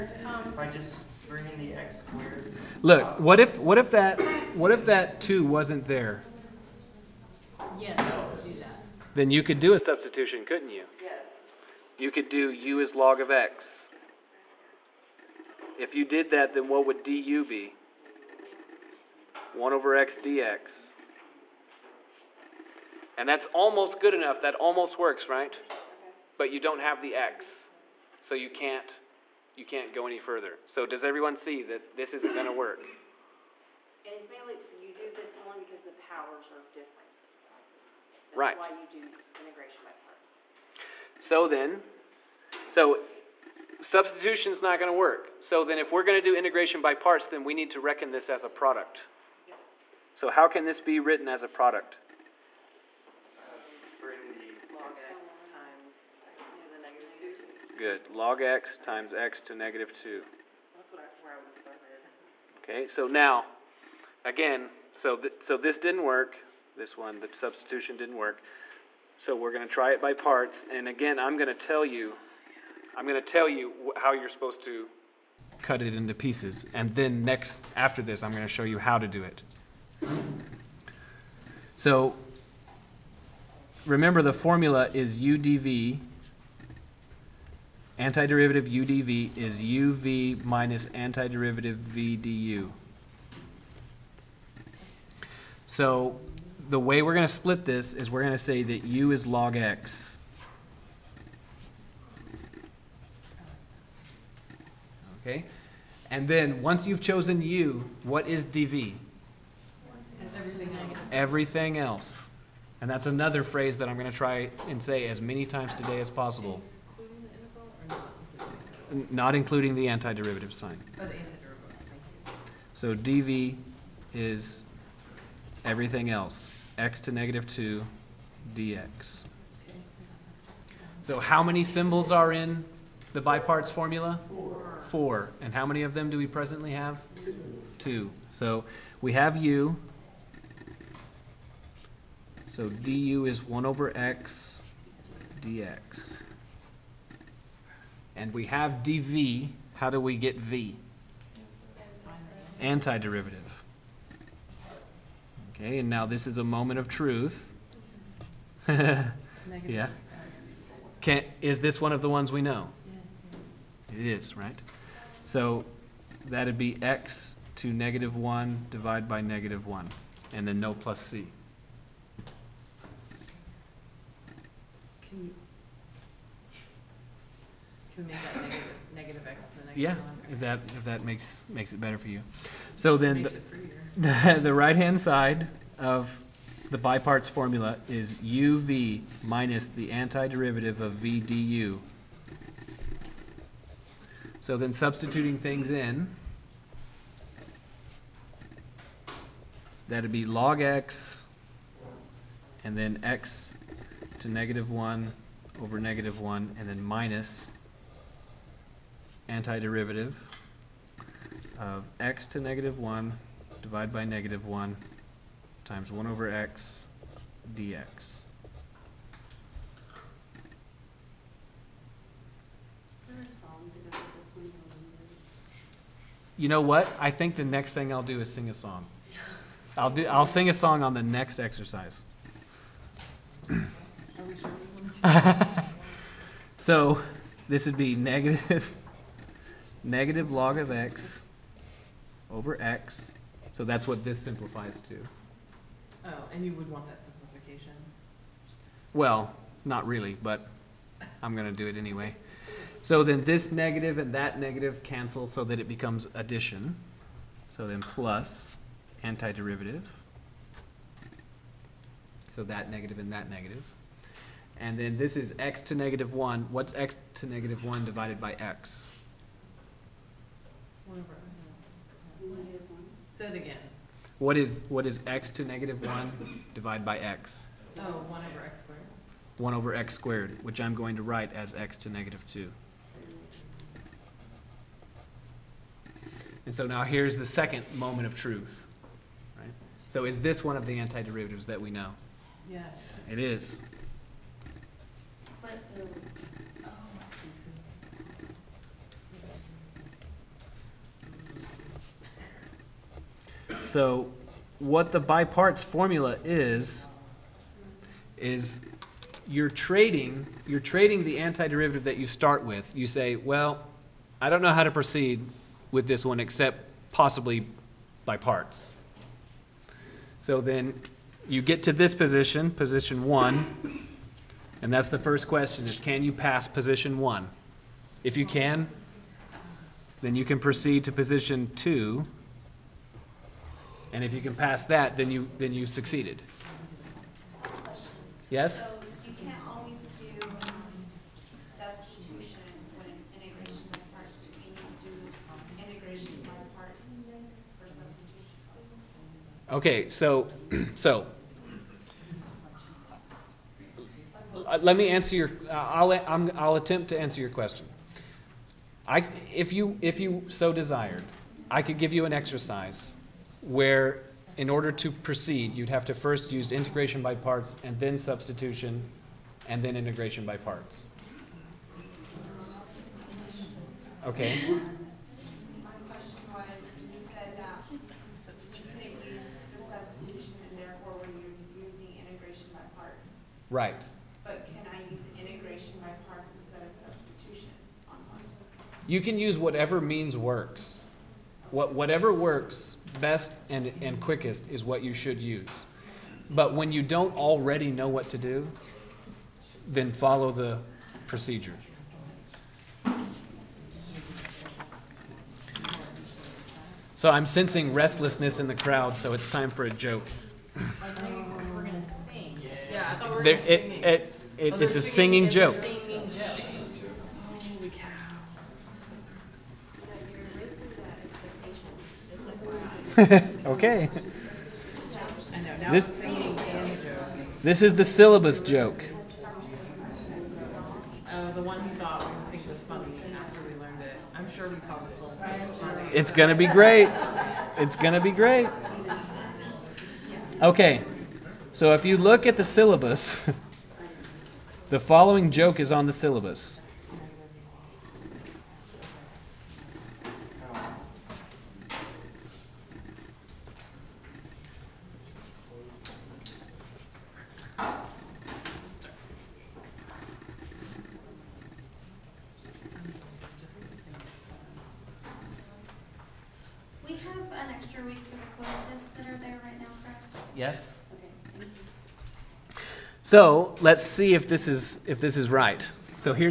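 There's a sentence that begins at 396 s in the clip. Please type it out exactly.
But when you don't already know what to do, then follow the procedure.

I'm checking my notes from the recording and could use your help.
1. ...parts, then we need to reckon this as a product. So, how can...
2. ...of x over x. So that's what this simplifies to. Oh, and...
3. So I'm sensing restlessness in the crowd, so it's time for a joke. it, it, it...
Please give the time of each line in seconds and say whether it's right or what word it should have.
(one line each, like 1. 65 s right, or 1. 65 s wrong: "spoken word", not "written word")
1. 46 s right
2. 240 s right
3. 406 s right.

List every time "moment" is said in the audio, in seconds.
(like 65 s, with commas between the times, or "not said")
156 s, 287 s.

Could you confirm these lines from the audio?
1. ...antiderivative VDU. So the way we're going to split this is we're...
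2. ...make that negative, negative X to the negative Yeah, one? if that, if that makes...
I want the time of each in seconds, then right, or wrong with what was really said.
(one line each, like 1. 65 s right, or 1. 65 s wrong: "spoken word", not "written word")
1. 90 s right
2. 178 s right.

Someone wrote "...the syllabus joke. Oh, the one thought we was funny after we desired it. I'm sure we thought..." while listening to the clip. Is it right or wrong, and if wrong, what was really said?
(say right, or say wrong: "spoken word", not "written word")
wrong: "learned", not "desired".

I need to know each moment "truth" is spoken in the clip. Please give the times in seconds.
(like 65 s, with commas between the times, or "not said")
156 s, 288 s.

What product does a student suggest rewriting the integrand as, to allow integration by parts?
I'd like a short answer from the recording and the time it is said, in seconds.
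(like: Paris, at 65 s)
Log x times x to negative 2, at 58 s.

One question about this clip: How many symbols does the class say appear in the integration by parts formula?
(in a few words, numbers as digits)
4.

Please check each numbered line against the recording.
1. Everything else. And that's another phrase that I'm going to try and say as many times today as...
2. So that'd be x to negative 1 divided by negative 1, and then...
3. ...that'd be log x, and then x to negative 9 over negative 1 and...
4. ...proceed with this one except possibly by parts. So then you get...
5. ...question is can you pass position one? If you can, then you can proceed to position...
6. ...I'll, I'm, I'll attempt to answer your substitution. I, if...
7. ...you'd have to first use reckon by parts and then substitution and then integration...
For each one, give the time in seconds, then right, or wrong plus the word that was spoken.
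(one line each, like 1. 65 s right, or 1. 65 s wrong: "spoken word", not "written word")
1. 111 s right
2. 165 s right
3. 199 s wrong: "1", not "9"
4. 314 s right
5. 325 s right
6. 355 s wrong: "question", not "substitution"
7. 365 s wrong: "integration", not "reckon".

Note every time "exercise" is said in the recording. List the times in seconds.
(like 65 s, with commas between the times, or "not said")
231 s, 362 s.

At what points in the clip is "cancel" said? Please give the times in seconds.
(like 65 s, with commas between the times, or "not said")
254 s.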